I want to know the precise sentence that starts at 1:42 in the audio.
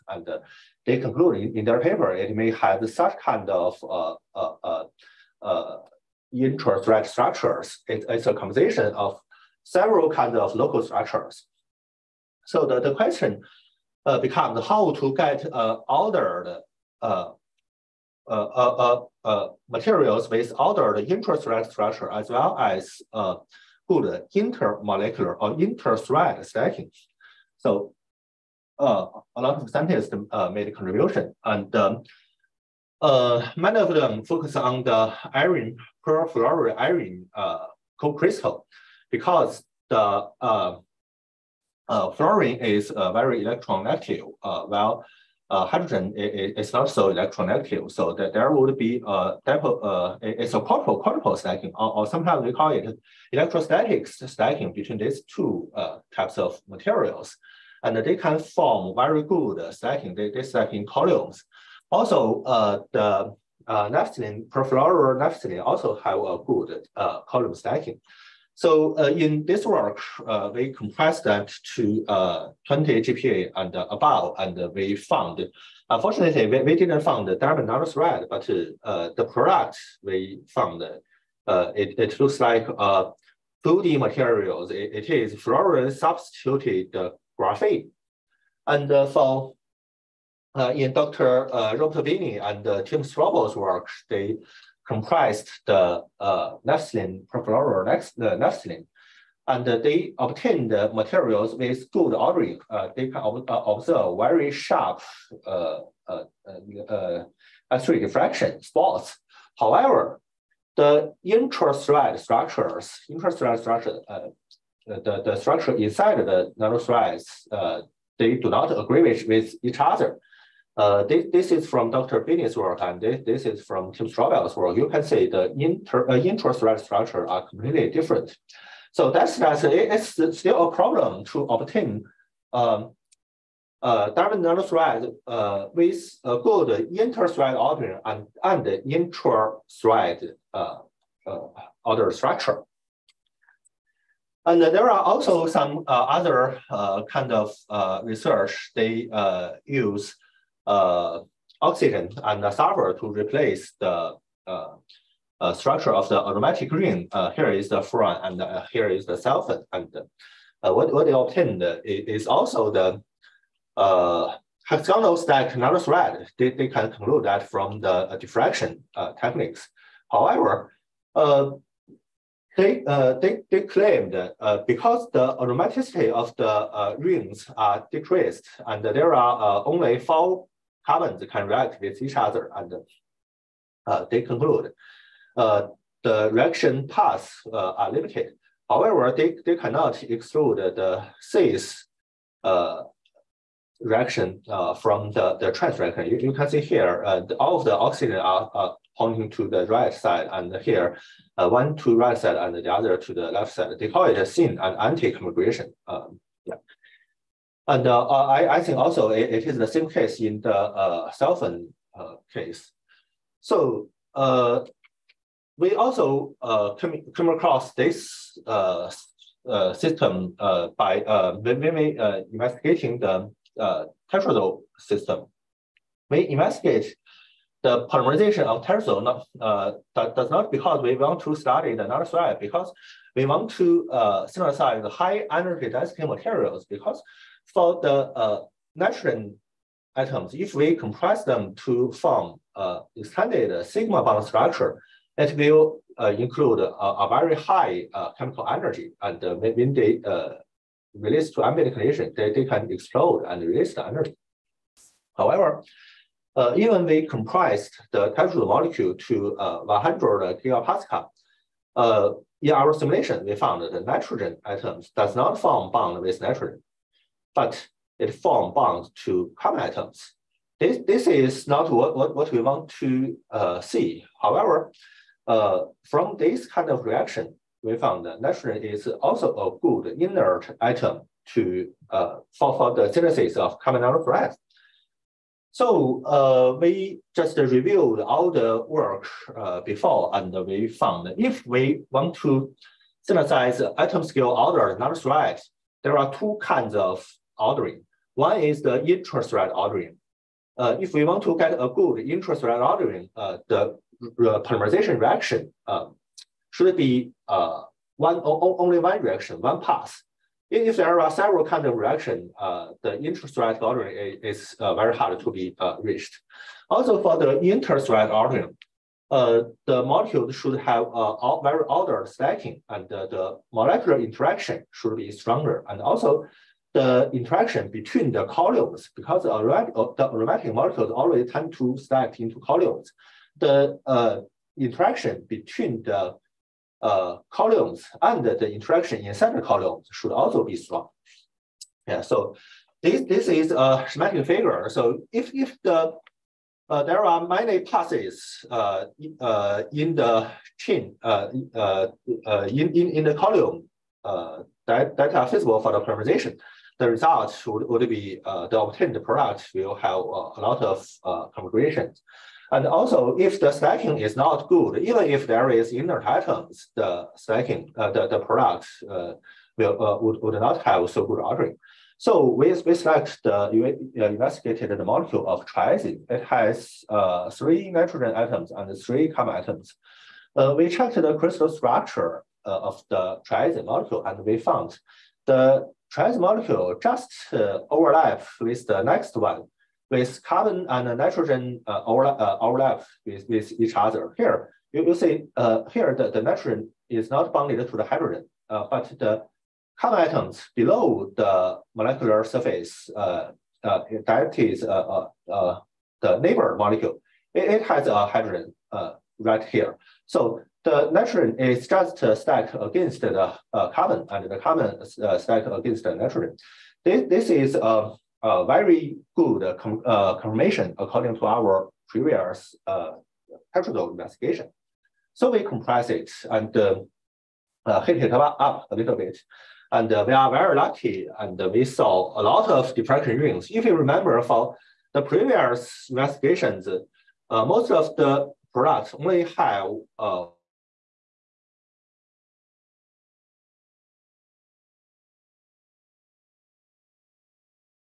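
Uh, they can ob uh, observe very sharp uh, uh, X-ray uh, uh, diffraction spots.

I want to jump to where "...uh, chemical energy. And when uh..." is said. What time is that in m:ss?
4:07.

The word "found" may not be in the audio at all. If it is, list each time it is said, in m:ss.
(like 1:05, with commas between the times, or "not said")
1:14, 1:20, 4:23, 4:37, 4:50, 6:24.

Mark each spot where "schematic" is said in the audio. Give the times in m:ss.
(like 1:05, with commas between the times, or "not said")
5:43.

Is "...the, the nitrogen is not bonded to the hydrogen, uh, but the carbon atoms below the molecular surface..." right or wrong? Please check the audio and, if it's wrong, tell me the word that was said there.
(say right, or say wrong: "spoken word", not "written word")
right.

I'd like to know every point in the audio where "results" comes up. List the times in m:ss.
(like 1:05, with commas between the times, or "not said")
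5:56.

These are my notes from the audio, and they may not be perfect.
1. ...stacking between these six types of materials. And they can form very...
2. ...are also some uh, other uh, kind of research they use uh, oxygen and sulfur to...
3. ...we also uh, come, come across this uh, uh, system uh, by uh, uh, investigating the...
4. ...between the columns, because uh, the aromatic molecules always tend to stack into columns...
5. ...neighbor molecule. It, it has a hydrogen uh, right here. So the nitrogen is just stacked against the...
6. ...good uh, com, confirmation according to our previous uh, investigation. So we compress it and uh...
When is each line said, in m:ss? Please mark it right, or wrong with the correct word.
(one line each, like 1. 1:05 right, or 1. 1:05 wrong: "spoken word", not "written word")
1. 0:54 wrong: "two", not "six"
2. 2:24 right
3. 3:35 right
4. 5:27 right
5. 6:46 right
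6. 6:59 right.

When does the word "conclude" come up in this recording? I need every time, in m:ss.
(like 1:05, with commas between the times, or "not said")
0:00, 2:46, 3:04.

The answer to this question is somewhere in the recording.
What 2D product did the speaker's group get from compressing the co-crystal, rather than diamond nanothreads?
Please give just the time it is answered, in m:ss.
1:25.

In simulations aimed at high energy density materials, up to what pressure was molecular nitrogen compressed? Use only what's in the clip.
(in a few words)
100 gigapascal.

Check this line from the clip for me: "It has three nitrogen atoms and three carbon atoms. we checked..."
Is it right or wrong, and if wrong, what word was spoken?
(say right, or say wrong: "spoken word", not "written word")
right.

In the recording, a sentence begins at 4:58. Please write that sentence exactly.
One is the interest rate ordering.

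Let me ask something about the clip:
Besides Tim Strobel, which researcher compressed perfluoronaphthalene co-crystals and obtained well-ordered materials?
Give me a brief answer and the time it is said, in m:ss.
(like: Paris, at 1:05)
Robert Bini, at 1:31.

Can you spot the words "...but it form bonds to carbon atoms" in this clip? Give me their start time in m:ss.
4:27.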